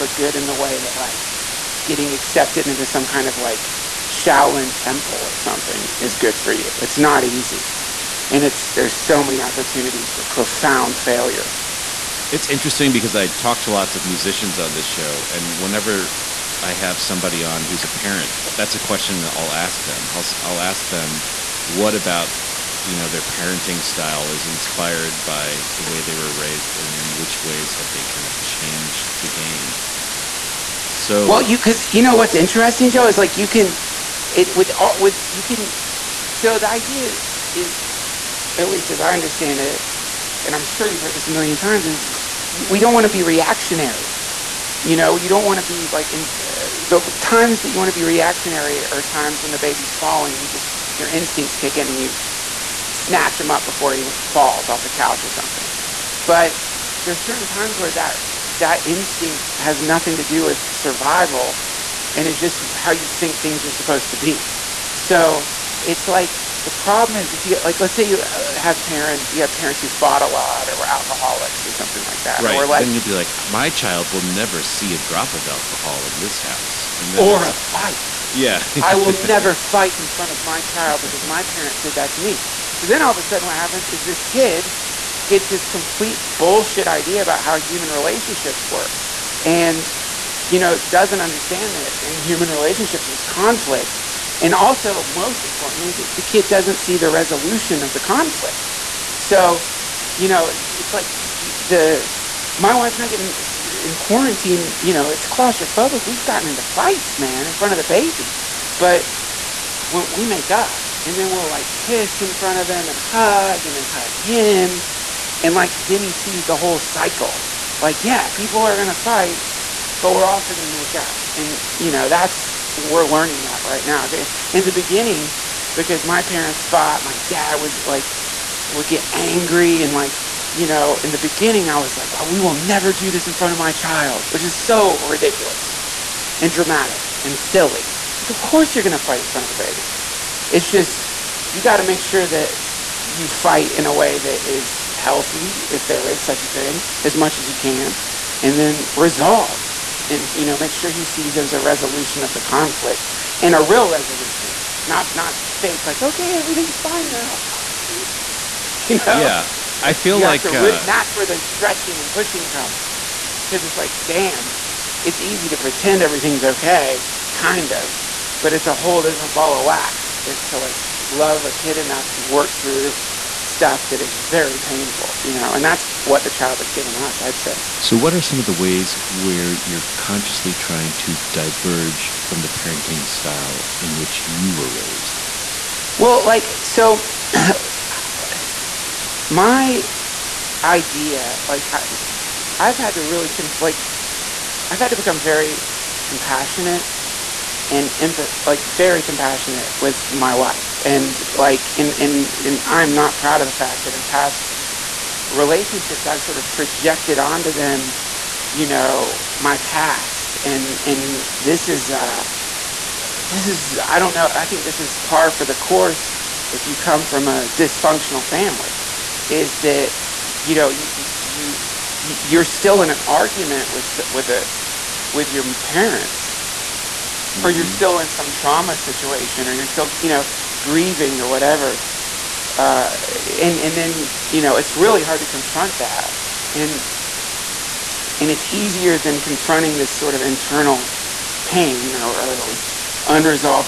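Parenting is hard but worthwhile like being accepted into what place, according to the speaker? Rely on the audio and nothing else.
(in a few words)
Shaolin temple.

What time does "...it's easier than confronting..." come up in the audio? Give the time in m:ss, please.
3:58.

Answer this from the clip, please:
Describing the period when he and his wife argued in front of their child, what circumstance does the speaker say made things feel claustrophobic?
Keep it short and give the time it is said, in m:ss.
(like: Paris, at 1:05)
quarantine, at 1:43.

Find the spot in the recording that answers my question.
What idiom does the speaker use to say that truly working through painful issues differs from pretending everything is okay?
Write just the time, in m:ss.
2:48.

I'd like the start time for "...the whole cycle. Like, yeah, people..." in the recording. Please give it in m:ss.
1:56.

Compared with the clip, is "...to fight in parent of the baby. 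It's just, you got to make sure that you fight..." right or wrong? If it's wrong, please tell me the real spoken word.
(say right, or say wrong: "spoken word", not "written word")
wrong: "front", not "parent".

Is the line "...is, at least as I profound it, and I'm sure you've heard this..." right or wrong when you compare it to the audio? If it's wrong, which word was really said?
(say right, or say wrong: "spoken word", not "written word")
wrong: "understand", not "profound".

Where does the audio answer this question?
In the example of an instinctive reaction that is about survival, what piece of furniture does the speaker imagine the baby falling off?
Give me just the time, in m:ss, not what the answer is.
0:54.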